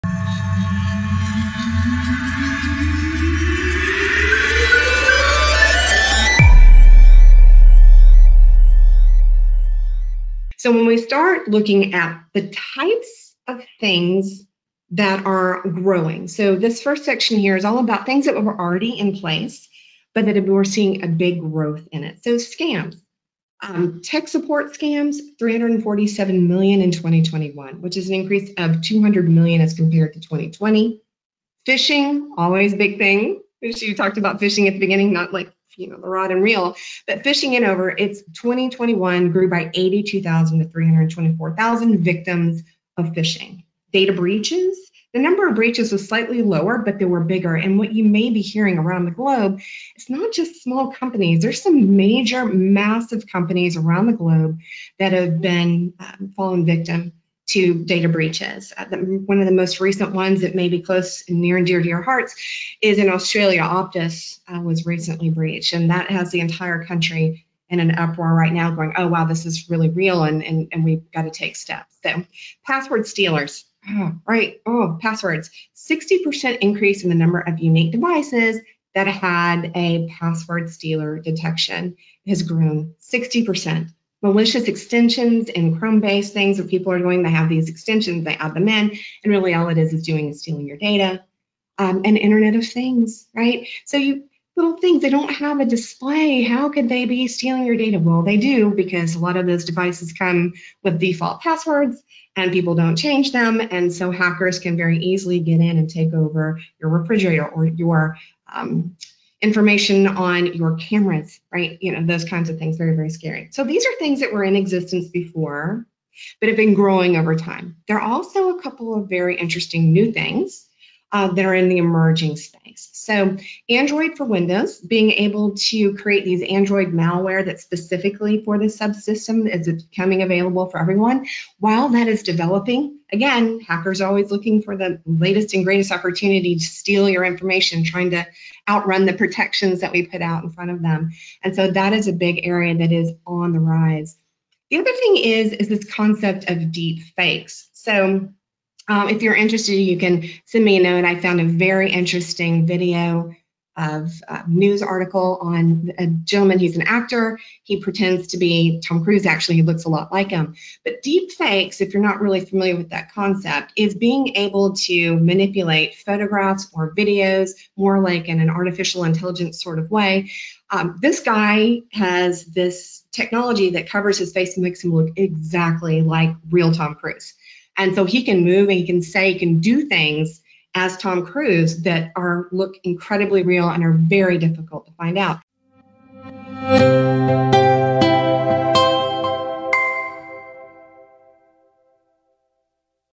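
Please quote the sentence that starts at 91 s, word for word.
Um, and Internet of Things, right?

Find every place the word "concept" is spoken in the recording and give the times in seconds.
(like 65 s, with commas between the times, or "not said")
145 s, 163 s.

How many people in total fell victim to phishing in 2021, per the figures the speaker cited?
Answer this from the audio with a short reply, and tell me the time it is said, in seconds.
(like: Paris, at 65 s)
324,000, at 40 s.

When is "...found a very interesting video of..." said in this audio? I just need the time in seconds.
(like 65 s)
151 s.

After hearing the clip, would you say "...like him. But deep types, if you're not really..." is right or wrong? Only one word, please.
wrong.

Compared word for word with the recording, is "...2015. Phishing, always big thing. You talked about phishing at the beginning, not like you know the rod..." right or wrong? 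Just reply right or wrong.
wrong.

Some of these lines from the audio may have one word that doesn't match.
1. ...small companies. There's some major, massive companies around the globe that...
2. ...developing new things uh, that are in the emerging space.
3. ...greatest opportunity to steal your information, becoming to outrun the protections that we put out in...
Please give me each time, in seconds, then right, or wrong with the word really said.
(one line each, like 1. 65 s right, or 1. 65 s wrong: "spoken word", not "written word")
1. 50 s right
2. 119 s wrong: "interesting", not "developing"
3. 135 s wrong: "trying", not "becoming".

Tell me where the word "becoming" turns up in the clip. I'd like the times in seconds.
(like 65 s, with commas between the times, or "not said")
129 s.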